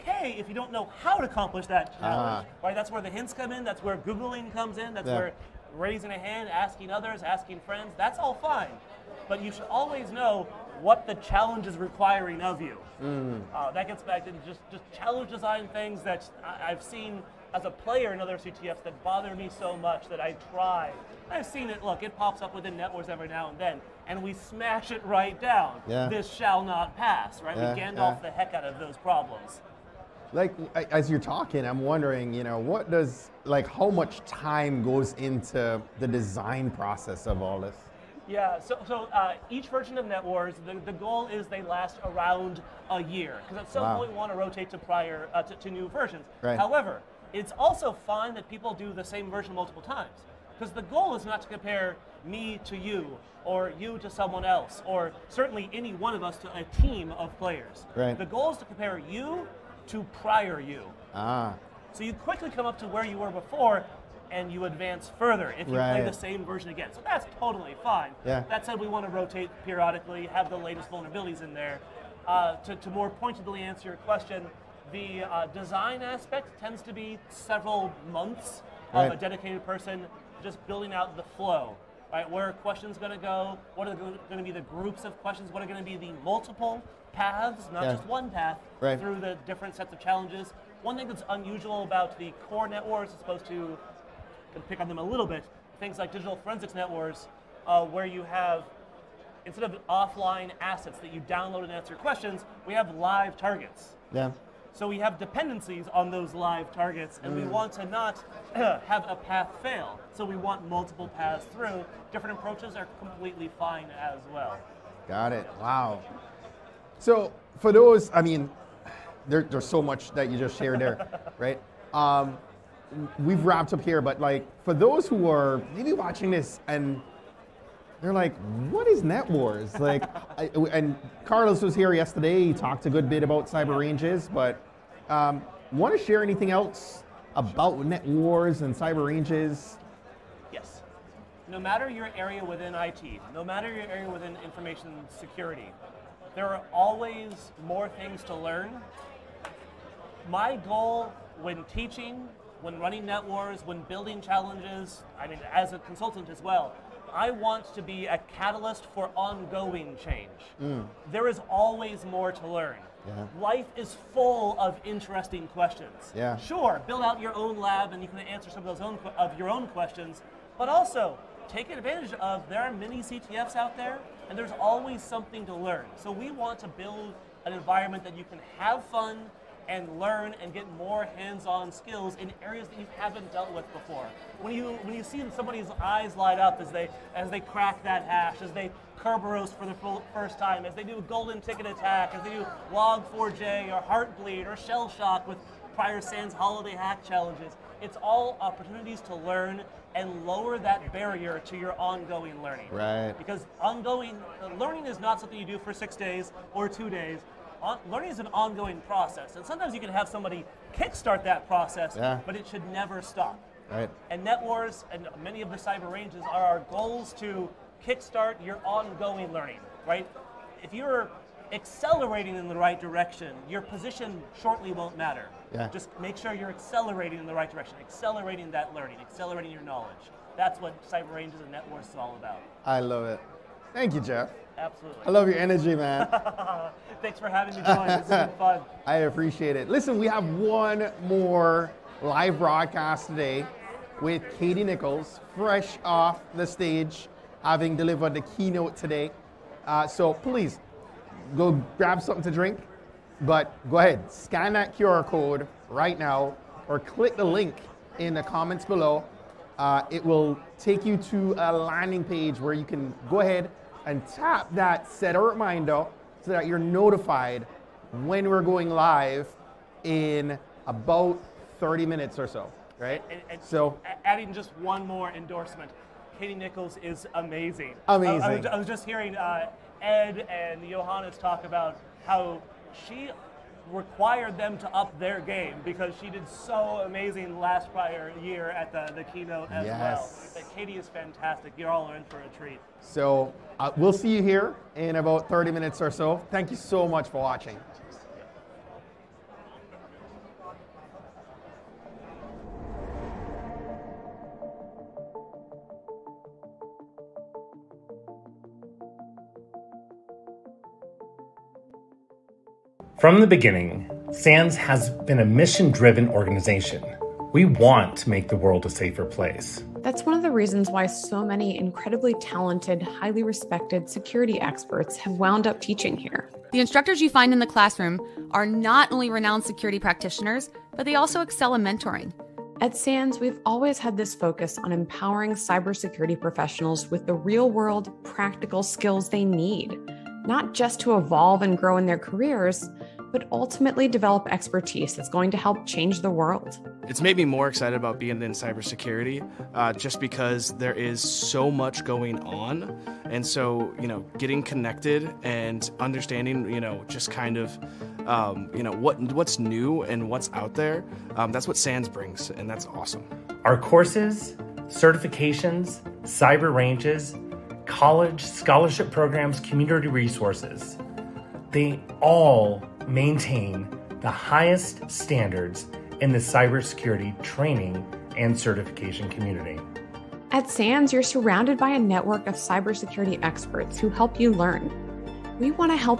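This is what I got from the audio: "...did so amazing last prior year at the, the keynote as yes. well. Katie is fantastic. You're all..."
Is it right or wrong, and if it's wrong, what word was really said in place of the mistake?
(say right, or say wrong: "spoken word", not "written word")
right.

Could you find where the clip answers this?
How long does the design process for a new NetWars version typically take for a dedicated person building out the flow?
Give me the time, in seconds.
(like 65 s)
77 s.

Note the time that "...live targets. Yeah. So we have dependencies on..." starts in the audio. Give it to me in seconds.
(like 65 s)
102 s.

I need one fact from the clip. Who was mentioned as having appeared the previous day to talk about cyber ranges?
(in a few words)
Carlos.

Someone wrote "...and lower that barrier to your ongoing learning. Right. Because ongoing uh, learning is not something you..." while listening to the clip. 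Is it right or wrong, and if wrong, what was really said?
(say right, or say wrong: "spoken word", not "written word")
right.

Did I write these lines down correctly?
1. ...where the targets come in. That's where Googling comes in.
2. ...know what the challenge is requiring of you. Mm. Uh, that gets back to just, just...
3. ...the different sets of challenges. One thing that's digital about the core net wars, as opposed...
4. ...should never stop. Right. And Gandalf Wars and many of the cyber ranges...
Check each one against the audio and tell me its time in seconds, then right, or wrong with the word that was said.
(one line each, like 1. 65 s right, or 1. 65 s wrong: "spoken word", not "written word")
1. 2 s wrong: "hints", not "targets"
2. 10 s right
3. 89 s wrong: "unusual", not "digital"
4. 212 s wrong: "Net", not "Gandalf".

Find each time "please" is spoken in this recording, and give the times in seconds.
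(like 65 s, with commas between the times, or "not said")
250 s.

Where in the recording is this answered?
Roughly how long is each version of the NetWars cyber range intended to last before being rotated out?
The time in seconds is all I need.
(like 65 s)
42 s.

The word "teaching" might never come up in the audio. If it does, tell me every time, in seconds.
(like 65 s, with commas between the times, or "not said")
151 s, 325 s.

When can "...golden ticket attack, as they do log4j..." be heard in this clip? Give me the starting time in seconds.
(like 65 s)
191 s.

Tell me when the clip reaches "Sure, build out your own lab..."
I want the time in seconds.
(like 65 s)
166 s.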